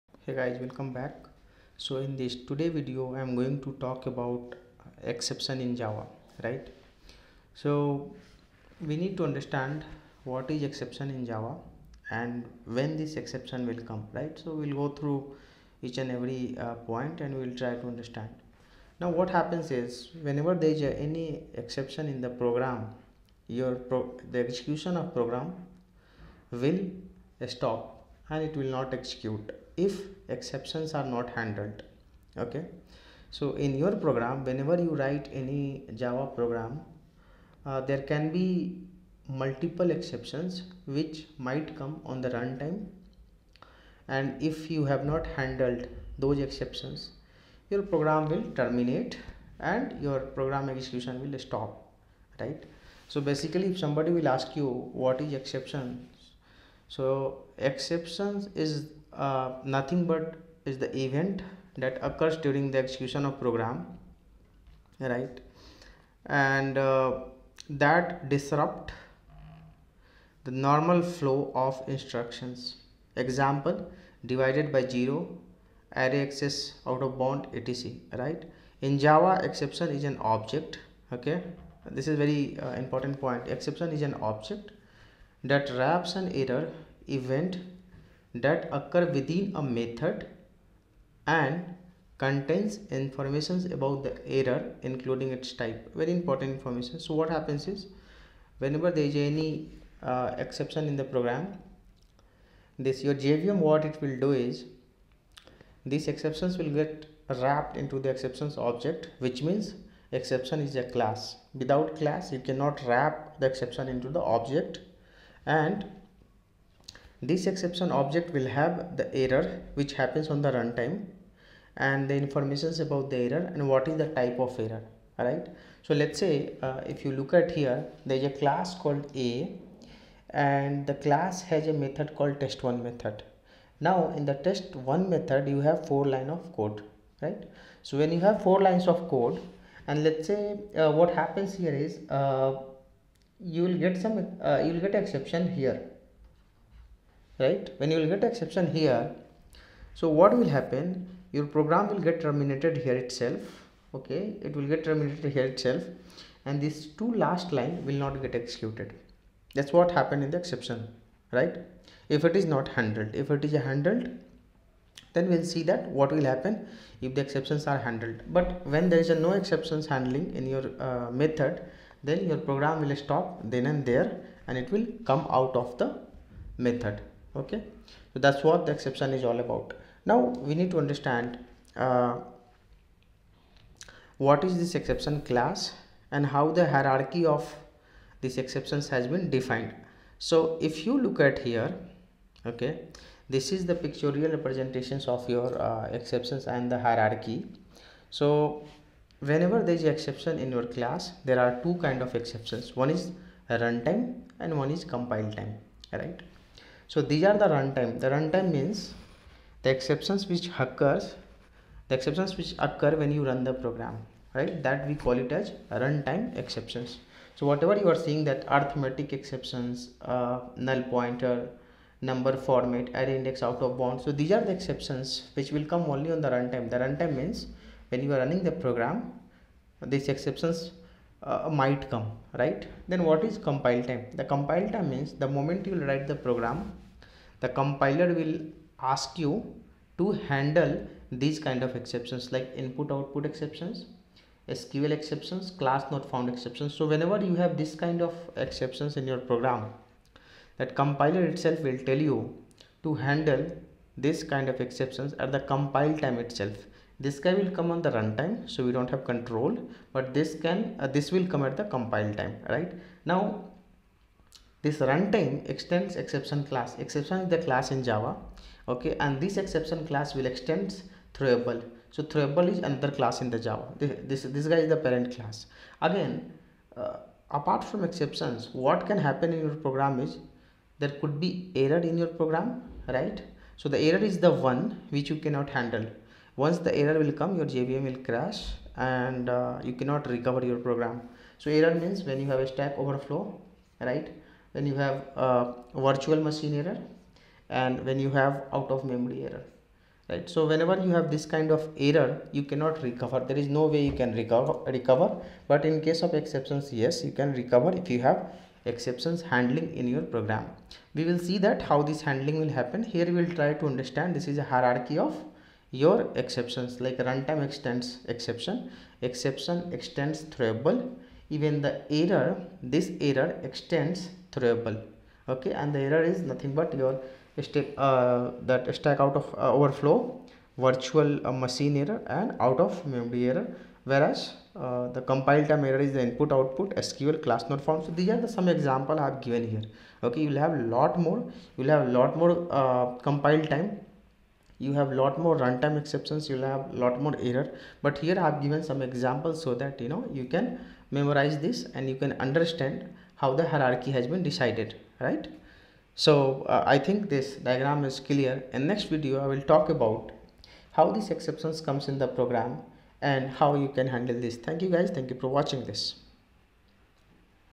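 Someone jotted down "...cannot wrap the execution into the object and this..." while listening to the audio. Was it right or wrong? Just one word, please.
wrong.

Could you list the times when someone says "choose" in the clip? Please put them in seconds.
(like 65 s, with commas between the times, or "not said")
not said.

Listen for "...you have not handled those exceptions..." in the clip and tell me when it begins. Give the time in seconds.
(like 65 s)
44 s.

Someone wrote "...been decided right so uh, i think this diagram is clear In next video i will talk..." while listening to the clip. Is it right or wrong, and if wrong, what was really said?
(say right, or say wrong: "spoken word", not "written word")
right.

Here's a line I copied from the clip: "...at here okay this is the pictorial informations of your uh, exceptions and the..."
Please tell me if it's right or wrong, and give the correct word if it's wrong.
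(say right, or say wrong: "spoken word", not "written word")
wrong: "representations", not "informations".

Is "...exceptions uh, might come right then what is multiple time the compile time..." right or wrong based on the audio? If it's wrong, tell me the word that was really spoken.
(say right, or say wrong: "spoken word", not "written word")
wrong: "compile", not "multiple".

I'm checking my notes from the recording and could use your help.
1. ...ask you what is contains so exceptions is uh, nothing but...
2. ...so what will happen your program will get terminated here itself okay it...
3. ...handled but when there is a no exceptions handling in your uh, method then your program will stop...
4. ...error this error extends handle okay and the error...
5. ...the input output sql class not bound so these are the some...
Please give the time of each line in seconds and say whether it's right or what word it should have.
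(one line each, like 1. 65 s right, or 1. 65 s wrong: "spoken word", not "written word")
1. 54 s wrong: "exceptions", not "contains"
2. 149 s right
3. 167 s right
4. 321 s wrong: "throwable", not "handle"
5. 335 s wrong: "found", not "bound".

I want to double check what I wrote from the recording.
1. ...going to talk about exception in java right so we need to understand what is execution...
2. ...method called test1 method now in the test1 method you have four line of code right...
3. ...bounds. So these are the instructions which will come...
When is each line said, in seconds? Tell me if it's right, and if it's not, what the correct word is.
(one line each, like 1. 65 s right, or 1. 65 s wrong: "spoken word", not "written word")
1. 3 s wrong: "exception", not "execution"
2. 131 s right
3. 223 s wrong: "exceptions", not "instructions".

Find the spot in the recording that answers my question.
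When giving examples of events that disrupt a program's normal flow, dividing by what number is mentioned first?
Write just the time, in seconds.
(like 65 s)
74 s.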